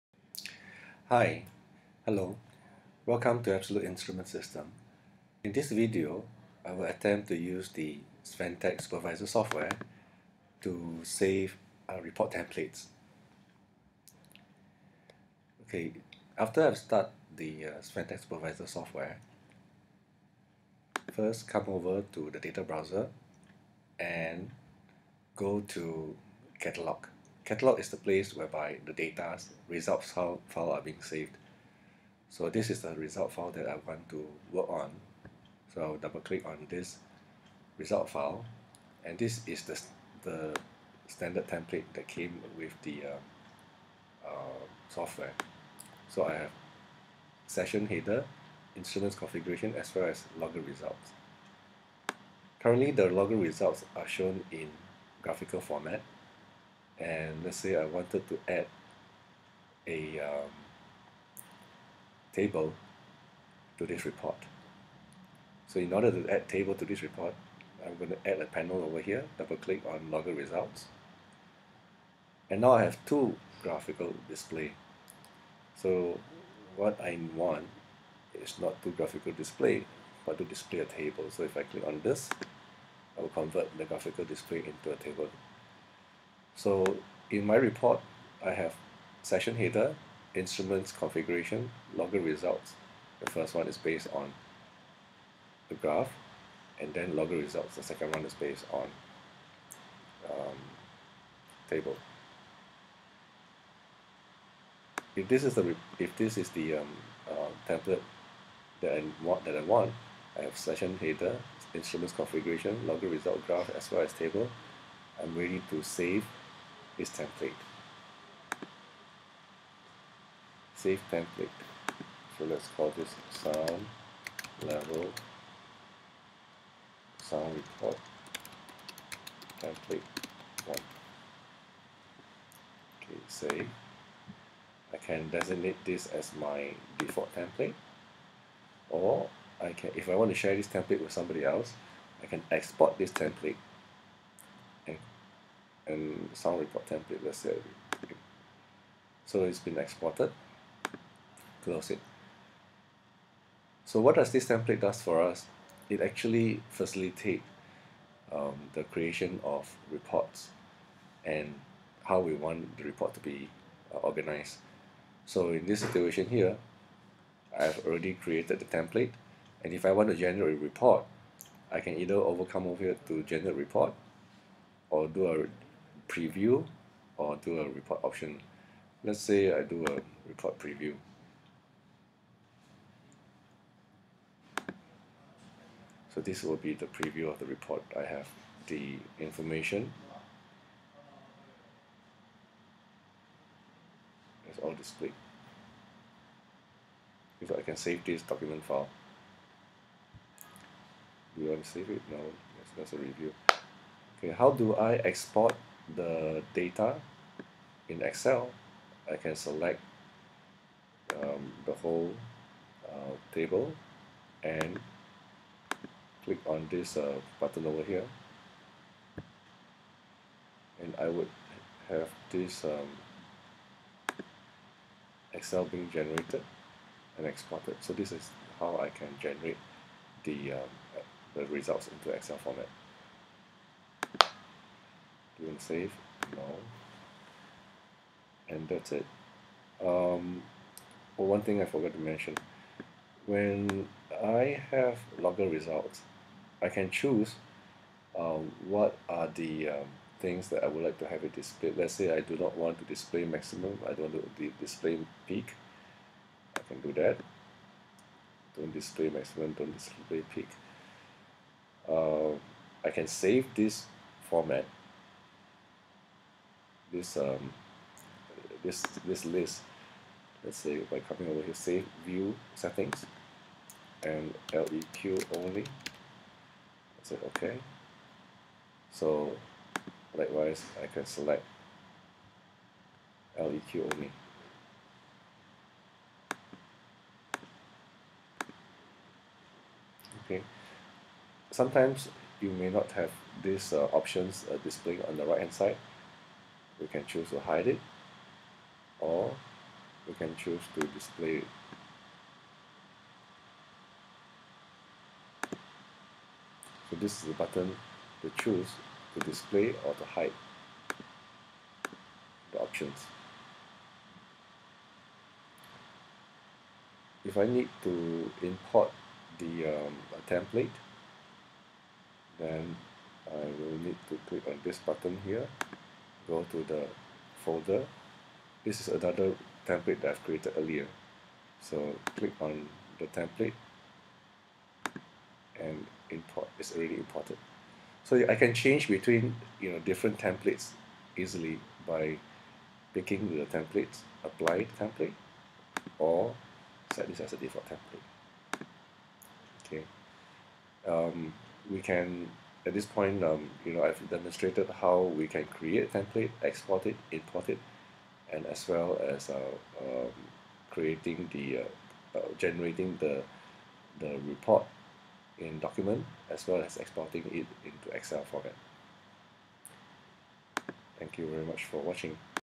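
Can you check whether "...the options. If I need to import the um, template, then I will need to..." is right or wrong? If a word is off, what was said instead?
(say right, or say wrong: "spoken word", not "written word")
right.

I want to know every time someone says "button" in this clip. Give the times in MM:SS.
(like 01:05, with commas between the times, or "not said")
03:37, 05:07, 05:24.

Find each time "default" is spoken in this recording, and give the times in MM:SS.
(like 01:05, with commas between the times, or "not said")
02:16, 05:47.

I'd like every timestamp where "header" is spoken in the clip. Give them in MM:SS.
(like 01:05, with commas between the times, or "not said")
00:47, 01:29, 01:50.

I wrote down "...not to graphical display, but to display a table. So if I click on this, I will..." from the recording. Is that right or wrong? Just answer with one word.
right.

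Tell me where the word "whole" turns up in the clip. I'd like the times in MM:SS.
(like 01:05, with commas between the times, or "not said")
03:31.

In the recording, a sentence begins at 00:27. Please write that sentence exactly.
Catalog is the place whereby the data results file, are being saved.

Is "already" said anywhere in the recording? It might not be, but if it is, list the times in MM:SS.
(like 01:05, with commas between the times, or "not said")
02:47, 05:36.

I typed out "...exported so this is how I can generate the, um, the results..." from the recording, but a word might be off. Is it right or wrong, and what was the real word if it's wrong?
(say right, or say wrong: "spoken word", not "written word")
right.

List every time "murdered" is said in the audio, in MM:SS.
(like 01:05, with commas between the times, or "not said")
not said.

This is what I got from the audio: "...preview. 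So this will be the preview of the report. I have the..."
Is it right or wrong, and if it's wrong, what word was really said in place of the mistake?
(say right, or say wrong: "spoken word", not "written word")
right.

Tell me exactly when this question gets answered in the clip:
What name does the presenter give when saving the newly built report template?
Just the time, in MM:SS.
02:07.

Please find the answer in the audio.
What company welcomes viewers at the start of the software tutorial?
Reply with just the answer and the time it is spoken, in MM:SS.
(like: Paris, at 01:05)
Absolute Instrument System, at 00:03.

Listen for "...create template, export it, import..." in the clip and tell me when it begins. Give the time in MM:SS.
05:55.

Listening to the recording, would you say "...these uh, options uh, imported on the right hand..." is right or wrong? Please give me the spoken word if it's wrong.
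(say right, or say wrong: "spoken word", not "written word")
wrong: "displayed", not "imported".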